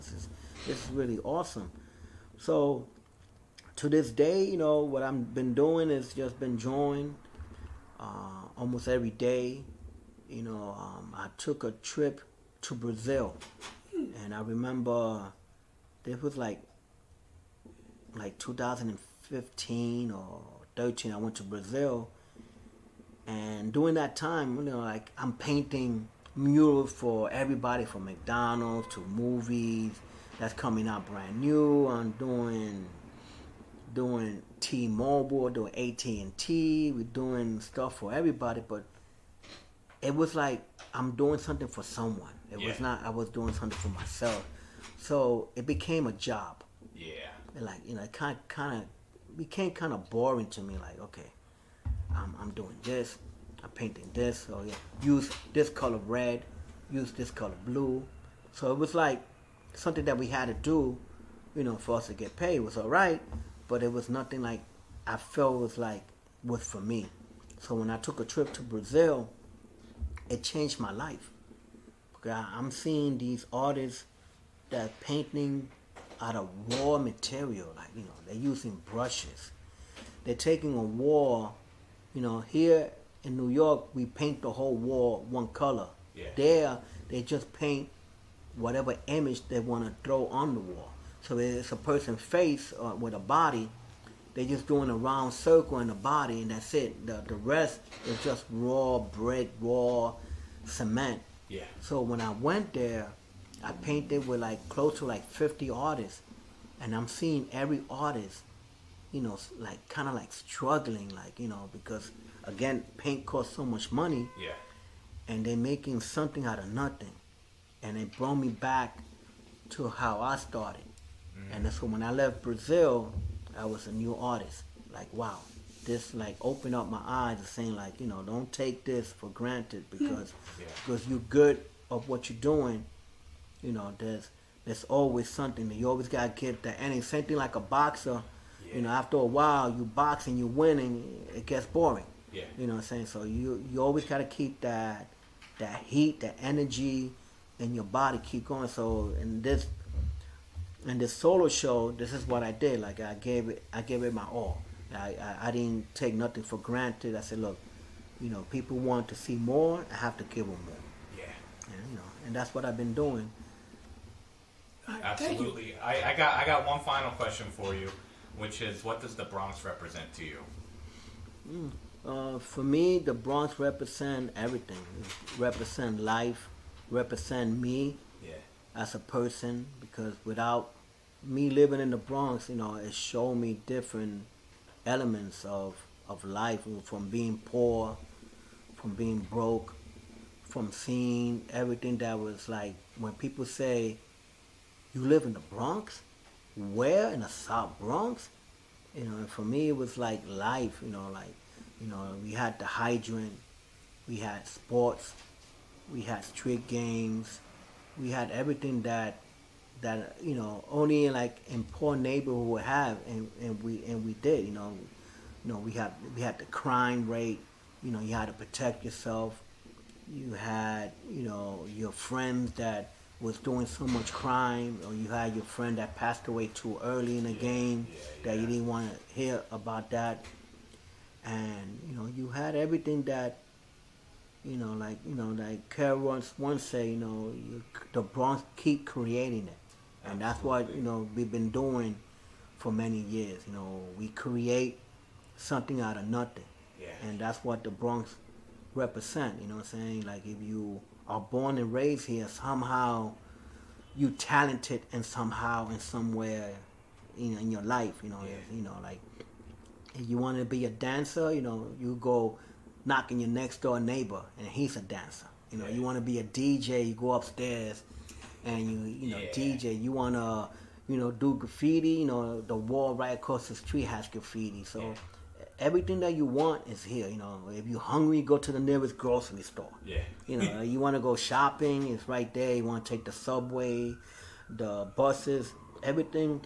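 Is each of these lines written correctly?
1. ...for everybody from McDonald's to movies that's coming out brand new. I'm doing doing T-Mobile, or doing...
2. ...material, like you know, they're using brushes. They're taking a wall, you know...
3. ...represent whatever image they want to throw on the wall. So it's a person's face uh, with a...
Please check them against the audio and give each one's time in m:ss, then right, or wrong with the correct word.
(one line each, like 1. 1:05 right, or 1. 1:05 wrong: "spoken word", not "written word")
1. 0:26 right
2. 1:16 right
3. 1:27 wrong: "paint", not "represent".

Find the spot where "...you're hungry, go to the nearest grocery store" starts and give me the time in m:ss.
4:37.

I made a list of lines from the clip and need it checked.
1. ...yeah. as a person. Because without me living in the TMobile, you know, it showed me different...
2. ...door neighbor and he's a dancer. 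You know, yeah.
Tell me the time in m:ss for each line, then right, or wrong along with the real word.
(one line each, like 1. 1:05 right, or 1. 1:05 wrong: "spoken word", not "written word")
1. 2:58 wrong: "Bronx", not "TMobile"
2. 4:23 right.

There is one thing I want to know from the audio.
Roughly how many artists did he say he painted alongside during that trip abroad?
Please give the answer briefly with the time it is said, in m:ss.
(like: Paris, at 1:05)
50, at 1:45.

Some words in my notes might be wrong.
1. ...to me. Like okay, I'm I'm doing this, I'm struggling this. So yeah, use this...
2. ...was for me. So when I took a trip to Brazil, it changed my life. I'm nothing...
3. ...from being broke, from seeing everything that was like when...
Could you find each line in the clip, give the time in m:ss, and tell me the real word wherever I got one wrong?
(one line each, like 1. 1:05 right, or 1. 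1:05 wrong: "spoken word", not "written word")
1. 0:50 wrong: "painting", not "struggling"
2. 1:06 wrong: "seeing", not "nothing"
3. 3:08 right.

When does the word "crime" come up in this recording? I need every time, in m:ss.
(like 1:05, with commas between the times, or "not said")
3:36, 3:44.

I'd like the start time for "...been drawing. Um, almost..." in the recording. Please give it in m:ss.
0:06.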